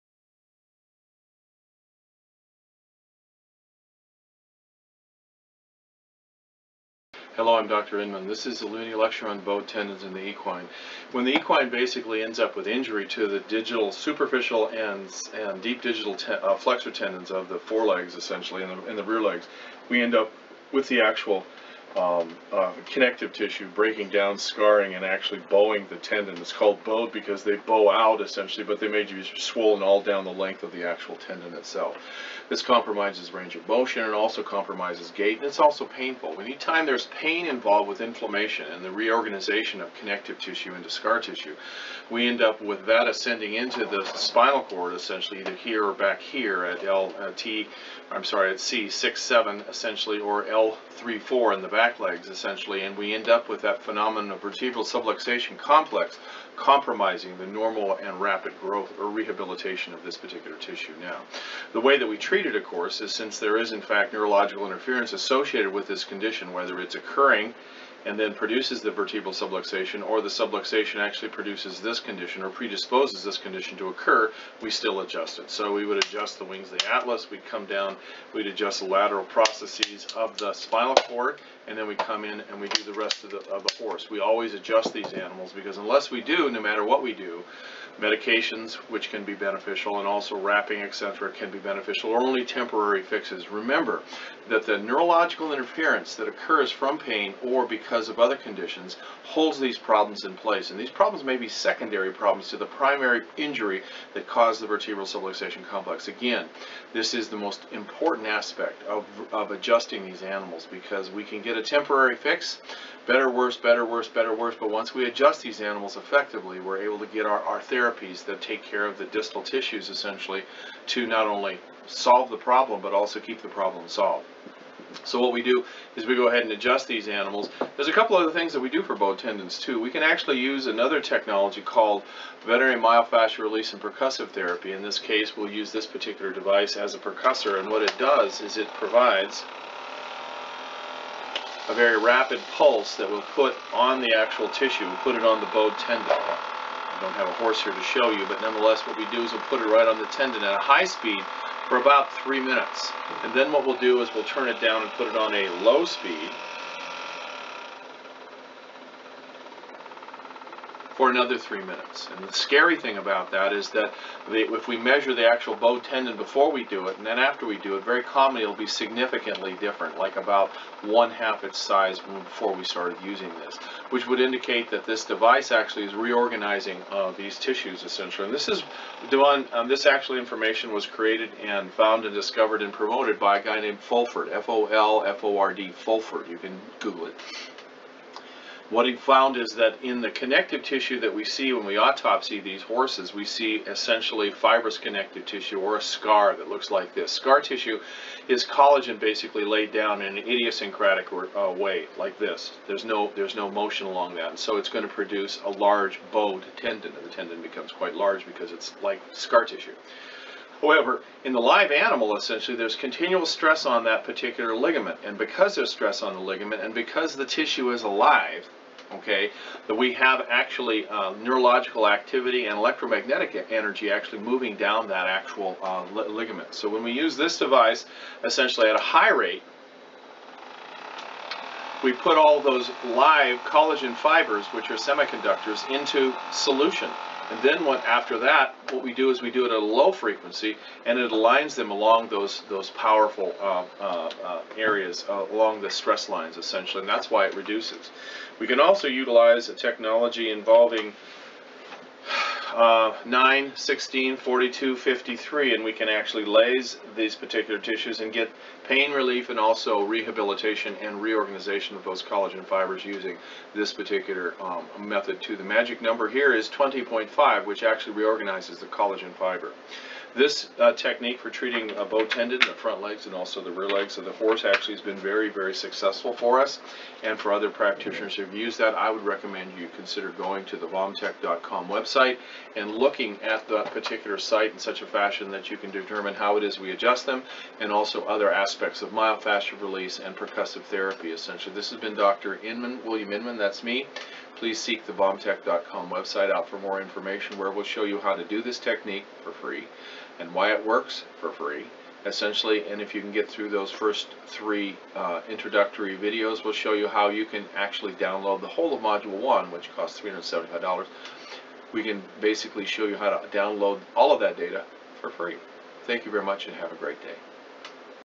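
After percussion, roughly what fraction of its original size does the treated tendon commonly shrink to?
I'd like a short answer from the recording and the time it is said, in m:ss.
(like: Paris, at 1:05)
one half, at 2:50.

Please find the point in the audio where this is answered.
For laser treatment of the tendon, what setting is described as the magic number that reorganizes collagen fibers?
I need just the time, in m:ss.
4:26.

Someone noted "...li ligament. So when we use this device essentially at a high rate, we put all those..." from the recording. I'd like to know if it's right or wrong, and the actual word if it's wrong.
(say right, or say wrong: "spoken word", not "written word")
right.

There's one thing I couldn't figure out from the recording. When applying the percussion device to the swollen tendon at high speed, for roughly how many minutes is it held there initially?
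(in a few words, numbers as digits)
3 minutes.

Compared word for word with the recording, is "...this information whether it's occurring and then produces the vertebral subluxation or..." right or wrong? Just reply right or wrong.
wrong.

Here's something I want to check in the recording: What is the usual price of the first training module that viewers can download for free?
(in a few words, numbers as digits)
$375.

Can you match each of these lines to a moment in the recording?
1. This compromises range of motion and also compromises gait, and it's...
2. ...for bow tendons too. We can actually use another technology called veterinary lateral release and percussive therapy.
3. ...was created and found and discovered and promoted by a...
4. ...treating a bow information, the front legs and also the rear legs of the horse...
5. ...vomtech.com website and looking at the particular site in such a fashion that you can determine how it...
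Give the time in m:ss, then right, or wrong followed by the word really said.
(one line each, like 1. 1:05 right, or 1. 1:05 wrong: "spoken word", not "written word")
1. 0:32 right
2. 2:08 wrong: "myofascial", not "lateral"
3. 3:00 right
4. 4:31 wrong: "tendon", not "information"
5. 4:40 right.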